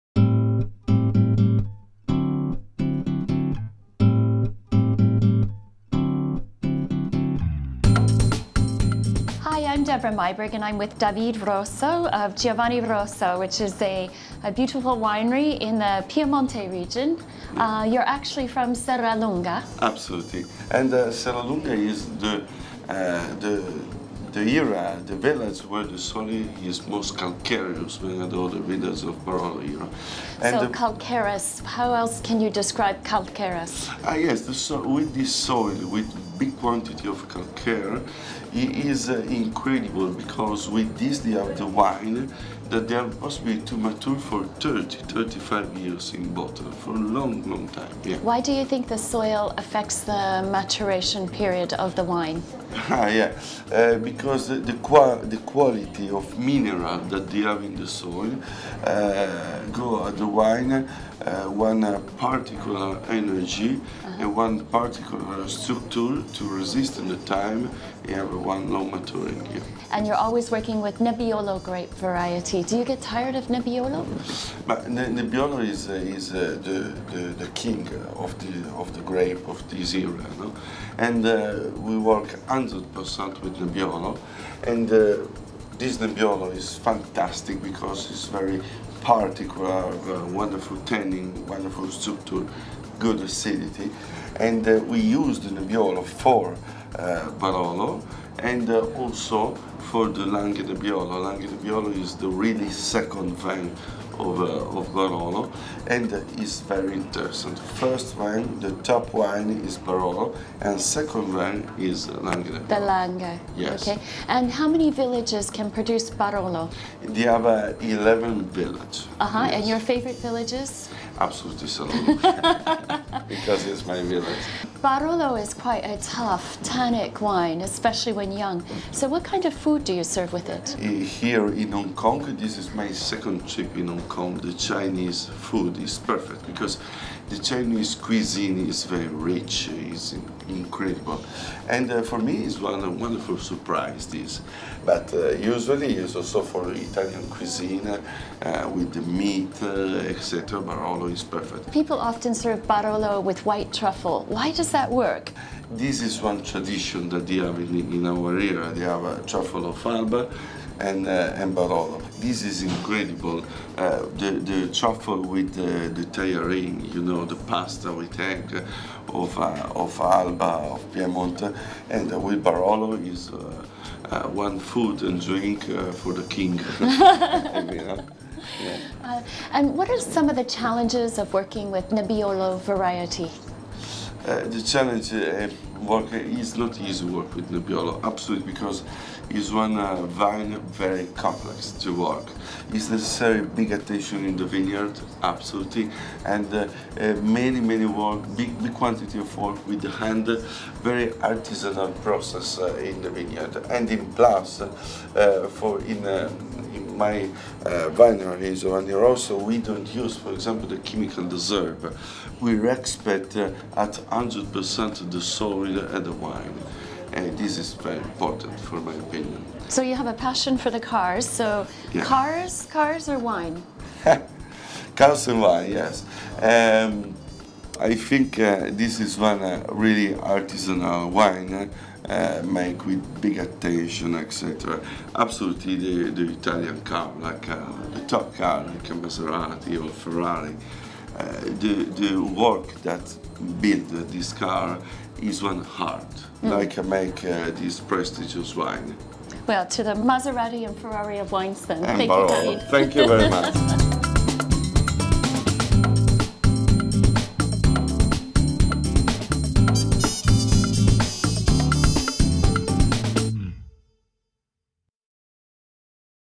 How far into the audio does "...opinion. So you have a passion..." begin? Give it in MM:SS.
03:38.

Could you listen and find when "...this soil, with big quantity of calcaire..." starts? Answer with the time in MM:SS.
00:35.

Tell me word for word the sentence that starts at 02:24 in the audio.
But uh, usually it's also for Italian cuisine uh, with the meat, etc.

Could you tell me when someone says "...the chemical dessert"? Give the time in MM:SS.
03:30.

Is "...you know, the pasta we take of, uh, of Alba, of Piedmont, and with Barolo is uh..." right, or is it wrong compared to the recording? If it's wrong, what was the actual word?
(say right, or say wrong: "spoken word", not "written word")
right.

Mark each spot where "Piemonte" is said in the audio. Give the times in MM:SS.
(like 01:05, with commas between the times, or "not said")
00:16.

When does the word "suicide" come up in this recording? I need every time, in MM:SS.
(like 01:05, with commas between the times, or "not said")
not said.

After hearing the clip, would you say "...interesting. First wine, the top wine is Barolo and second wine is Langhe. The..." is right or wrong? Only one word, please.
right.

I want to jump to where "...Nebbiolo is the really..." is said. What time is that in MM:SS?
01:41.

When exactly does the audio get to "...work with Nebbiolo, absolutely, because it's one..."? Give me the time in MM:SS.
03:07.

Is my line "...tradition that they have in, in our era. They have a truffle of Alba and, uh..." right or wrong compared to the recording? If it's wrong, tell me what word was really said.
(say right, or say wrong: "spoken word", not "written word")
right.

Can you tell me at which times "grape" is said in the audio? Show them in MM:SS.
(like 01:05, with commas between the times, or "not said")
01:11, 01:19.